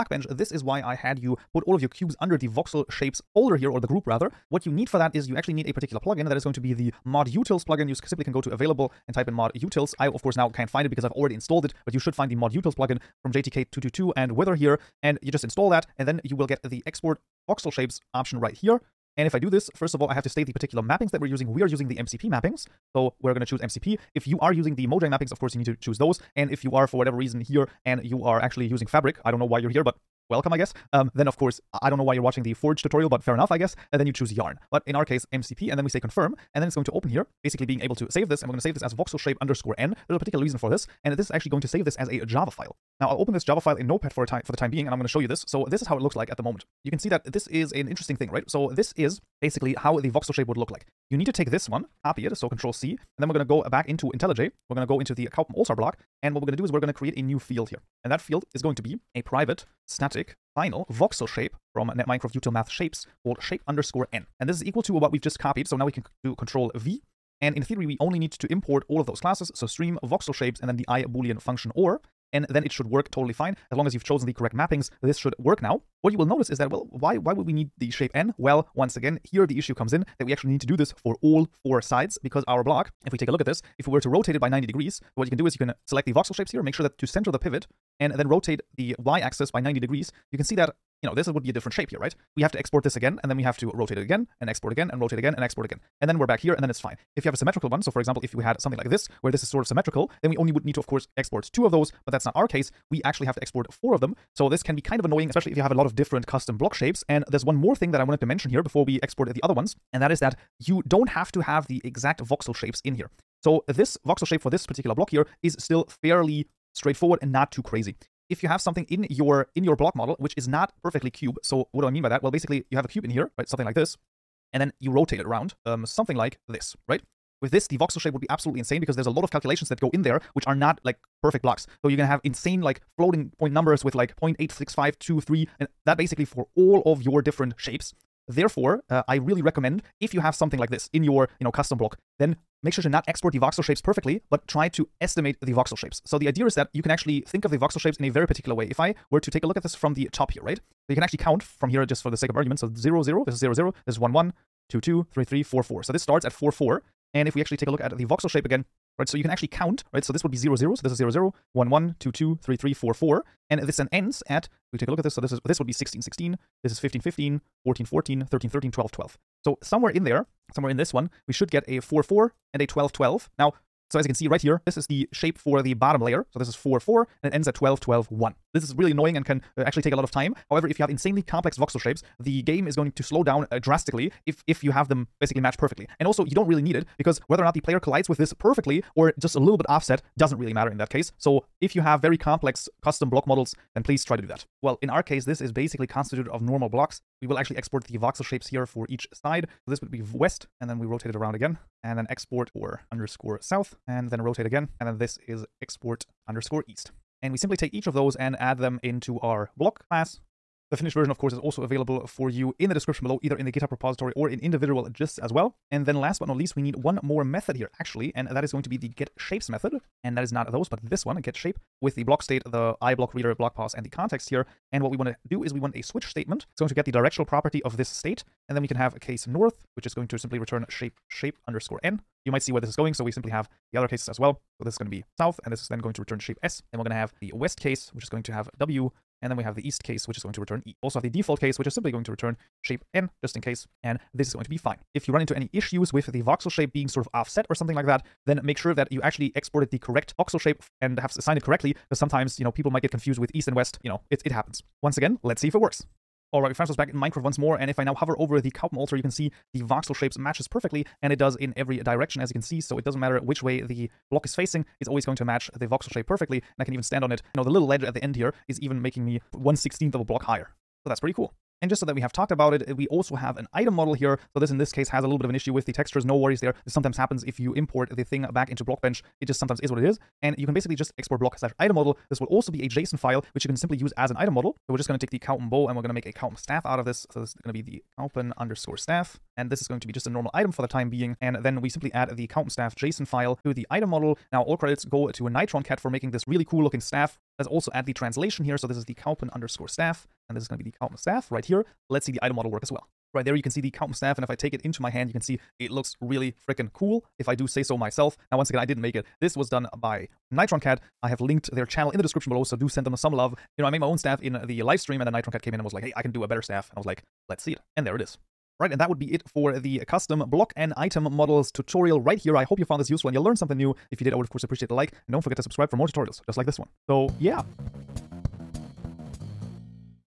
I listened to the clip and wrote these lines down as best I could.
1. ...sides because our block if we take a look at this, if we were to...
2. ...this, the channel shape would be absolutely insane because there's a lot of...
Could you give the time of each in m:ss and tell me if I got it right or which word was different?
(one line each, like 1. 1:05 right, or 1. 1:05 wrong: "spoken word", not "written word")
1. 1:21 right
2. 2:07 wrong: "voxel", not "channel".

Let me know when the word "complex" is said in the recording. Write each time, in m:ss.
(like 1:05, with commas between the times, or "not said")
3:01, 3:12.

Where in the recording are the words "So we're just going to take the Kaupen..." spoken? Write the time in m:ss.
4:44.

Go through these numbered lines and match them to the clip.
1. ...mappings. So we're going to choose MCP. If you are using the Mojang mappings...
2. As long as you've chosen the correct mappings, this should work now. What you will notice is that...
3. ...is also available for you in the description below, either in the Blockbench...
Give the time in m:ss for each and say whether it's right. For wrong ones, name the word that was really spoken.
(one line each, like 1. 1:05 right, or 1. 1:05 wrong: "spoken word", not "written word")
1. 0:22 right
2. 1:13 right
3. 3:31 wrong: "GitHub", not "Blockbench".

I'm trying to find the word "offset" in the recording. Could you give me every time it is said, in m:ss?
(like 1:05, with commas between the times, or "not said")
3:09, 4:07.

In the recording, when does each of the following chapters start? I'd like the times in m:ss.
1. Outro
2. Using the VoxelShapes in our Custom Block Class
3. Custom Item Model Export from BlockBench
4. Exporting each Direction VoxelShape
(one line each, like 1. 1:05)
1. 5:18
2. 0:54
3. 4:31
4. 3:13.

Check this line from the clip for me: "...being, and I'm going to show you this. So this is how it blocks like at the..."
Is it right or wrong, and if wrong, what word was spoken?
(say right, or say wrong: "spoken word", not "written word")
wrong: "looks", not "blocks".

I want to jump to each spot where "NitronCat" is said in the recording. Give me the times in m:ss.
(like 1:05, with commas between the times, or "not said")
4:55, 5:10, 5:15.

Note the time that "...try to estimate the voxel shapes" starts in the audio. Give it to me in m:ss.
2:24.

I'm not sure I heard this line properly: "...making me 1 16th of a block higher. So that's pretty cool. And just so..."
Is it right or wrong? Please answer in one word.
right.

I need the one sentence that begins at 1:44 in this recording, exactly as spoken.
So this can be kind of annoying, especially if you have a lot of different custom block shapes.